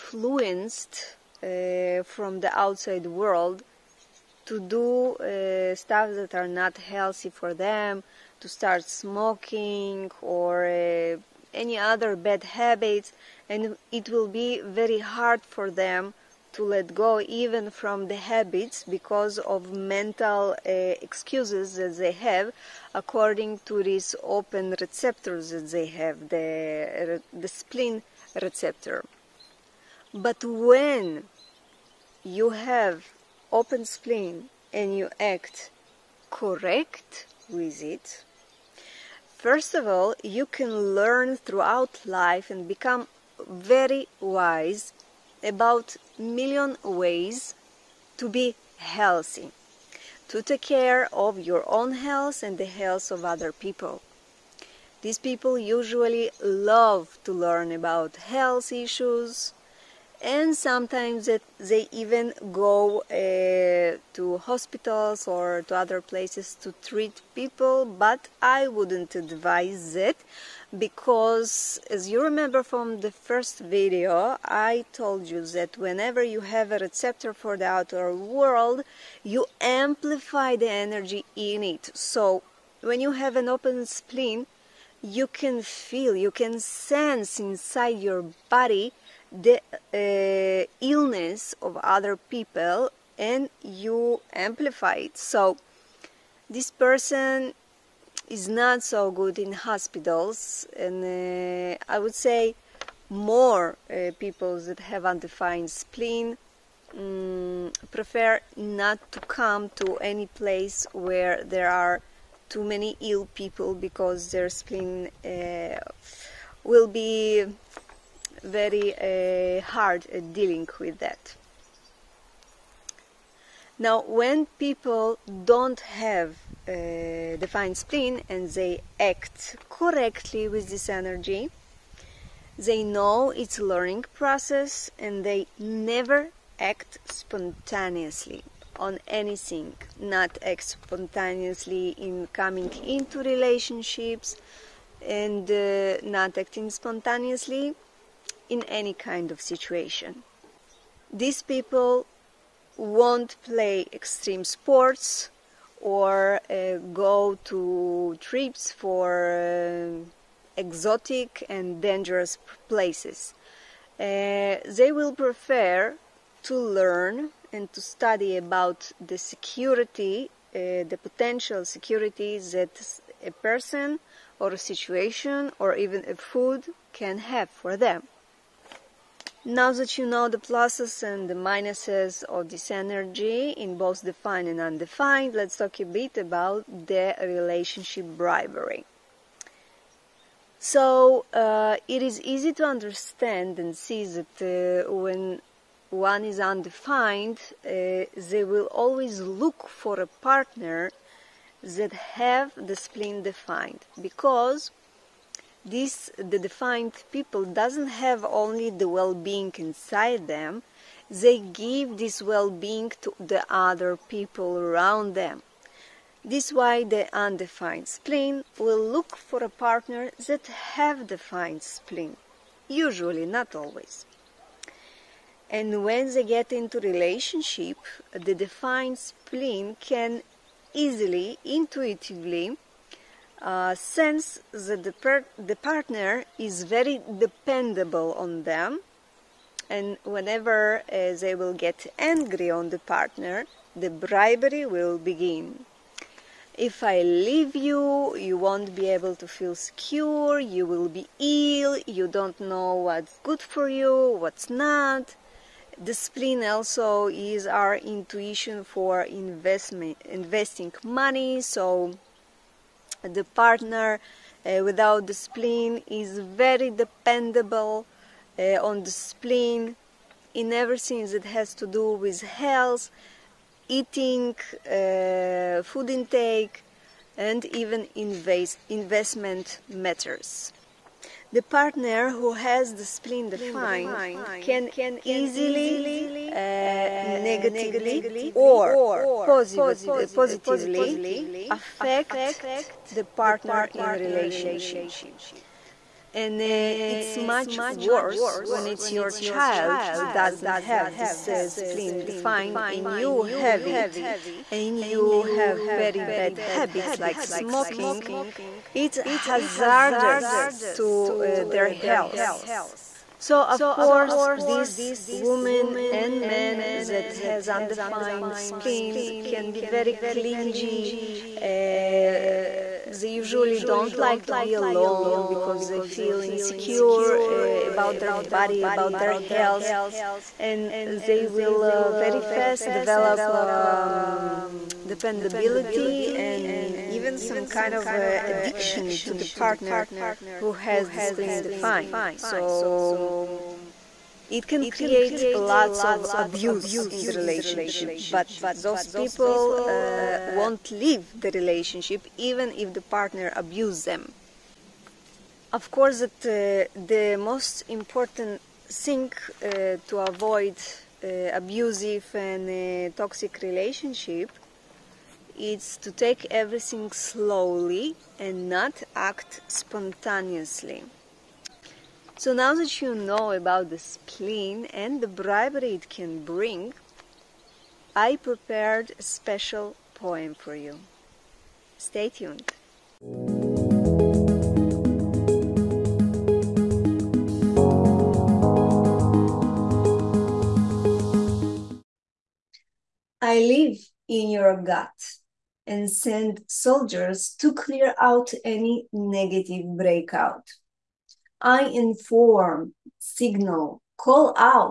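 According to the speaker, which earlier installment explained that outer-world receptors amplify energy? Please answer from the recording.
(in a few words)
the first video.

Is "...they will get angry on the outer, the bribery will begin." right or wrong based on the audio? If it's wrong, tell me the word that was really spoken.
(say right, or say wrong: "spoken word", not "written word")
wrong: "partner", not "outer".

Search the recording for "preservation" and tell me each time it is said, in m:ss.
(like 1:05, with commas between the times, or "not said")
not said.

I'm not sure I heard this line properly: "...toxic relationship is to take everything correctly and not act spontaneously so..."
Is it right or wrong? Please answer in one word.
wrong.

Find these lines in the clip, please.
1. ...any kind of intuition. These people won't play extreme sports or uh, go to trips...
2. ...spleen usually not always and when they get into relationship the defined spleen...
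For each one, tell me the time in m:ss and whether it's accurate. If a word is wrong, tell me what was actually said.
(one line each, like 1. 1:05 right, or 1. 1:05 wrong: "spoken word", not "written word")
1. 2:28 wrong: "situation", not "intuition"
2. 3:41 right.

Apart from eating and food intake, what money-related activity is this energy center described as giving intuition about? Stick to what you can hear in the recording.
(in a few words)
investing money.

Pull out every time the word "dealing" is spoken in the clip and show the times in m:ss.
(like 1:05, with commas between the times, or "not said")
2:00.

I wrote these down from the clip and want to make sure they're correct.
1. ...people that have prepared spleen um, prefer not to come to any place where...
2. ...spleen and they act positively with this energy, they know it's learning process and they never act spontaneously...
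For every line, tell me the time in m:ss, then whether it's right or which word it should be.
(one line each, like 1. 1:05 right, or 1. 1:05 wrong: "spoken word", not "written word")
1. 1:44 wrong: "undefined", not "prepared"
2. 2:07 wrong: "correctly", not "positively".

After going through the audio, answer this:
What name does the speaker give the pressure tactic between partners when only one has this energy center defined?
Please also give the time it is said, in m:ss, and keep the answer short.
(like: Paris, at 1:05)
relationship bribery, at 3:07.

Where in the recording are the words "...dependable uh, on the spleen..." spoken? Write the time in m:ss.
4:26.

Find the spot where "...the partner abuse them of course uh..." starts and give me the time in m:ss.
5:52.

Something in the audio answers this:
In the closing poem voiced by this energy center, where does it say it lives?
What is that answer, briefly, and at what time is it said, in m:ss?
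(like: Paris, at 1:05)
your gut, at 6:34.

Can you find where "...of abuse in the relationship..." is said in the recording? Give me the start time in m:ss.
5:45.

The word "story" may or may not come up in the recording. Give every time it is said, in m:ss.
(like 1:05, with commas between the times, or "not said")
not said.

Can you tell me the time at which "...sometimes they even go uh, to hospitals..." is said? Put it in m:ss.
1:00.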